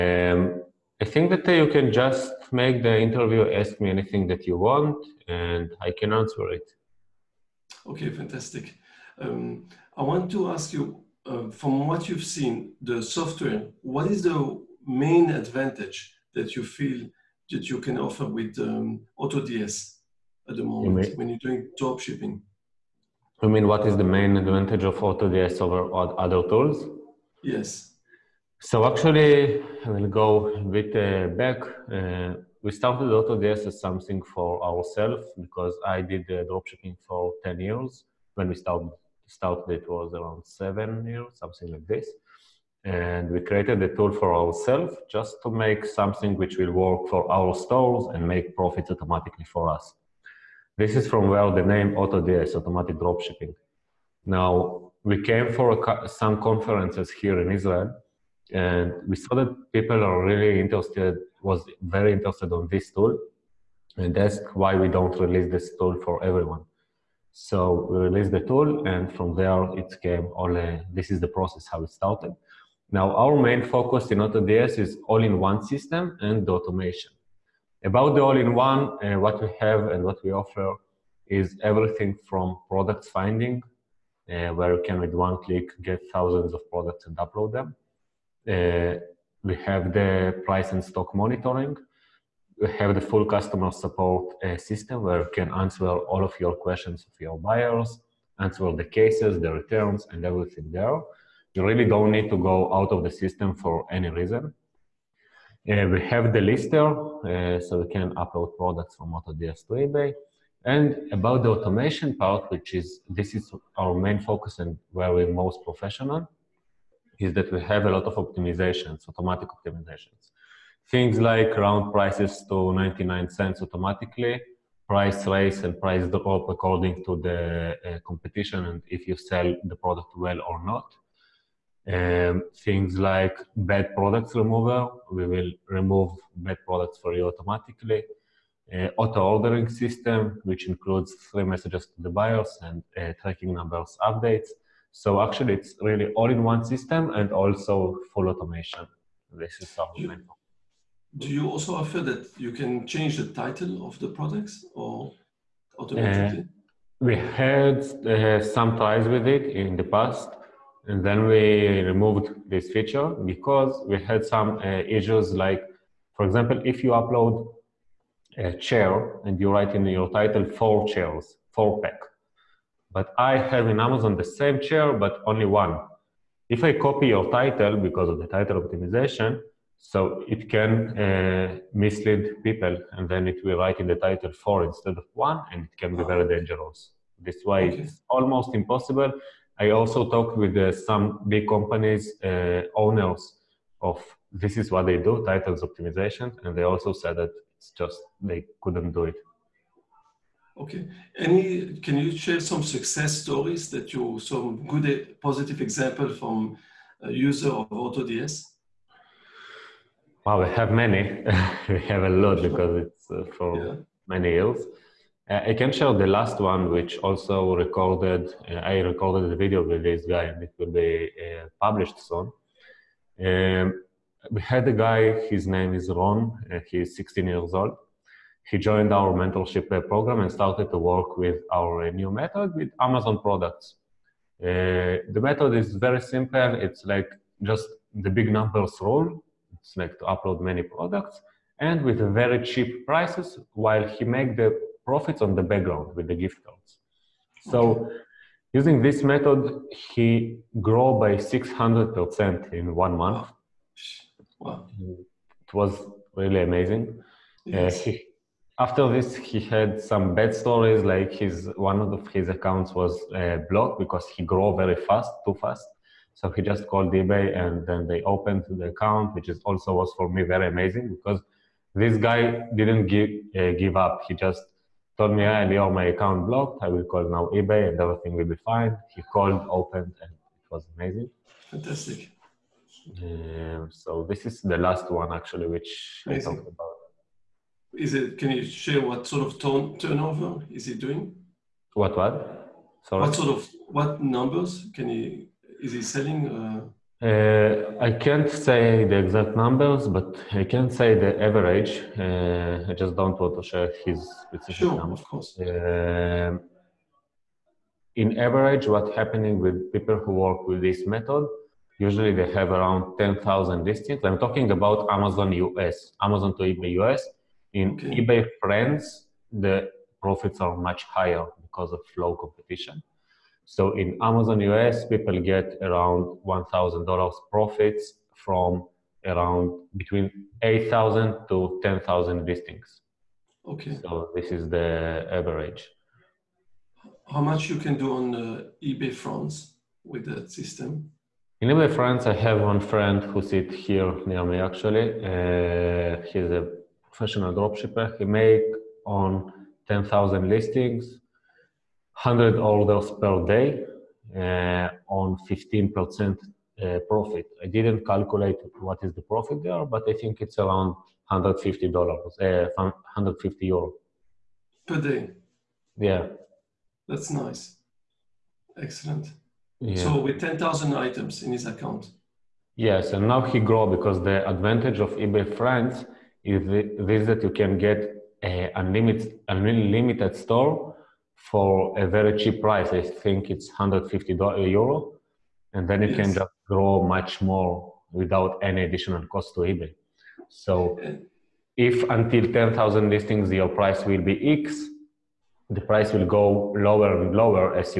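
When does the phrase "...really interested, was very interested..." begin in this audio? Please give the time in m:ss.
1:00.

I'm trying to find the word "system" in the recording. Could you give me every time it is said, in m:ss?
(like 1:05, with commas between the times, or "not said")
1:15, 1:34, 1:43, 2:19, 2:26, 5:40.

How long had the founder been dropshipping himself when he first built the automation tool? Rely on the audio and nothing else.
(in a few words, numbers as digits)
10 years.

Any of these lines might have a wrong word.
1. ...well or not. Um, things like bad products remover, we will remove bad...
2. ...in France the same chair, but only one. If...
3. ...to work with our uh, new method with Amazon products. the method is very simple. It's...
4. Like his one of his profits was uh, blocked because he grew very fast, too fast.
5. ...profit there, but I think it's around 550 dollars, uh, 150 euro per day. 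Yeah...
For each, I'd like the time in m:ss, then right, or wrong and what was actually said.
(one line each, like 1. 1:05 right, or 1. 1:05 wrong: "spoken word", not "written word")
1. 2:10 right
2. 2:53 wrong: "Amazon", not "France"
3. 3:50 right
4. 4:20 wrong: "accounts", not "profits"
5. 5:59 wrong: "150", not "550".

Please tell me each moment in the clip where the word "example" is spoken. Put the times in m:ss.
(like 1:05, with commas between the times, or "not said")
2:46, 3:25.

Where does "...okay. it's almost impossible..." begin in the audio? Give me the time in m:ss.
3:07.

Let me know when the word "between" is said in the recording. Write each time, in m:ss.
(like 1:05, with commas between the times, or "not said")
5:29.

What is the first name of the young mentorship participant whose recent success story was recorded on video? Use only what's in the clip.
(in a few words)
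Ron.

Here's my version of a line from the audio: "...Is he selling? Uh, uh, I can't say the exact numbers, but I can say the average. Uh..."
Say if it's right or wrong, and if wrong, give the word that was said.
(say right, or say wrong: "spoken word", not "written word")
right.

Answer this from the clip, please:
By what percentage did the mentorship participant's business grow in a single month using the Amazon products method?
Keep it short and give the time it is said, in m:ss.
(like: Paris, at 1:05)
600%, at 4:11.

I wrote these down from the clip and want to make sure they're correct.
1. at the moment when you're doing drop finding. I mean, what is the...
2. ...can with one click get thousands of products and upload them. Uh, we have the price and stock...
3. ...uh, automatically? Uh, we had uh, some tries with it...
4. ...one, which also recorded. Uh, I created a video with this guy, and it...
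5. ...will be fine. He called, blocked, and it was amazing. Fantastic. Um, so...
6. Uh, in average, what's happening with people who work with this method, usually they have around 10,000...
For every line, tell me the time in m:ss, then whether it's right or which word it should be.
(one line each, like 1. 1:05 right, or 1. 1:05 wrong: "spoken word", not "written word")
1. 0:20 wrong: "shipping", not "finding"
2. 1:24 right
3. 2:35 right
4. 3:36 wrong: "recorded", not "created"
5. 4:38 wrong: "opened", not "blocked"
6. 5:05 right.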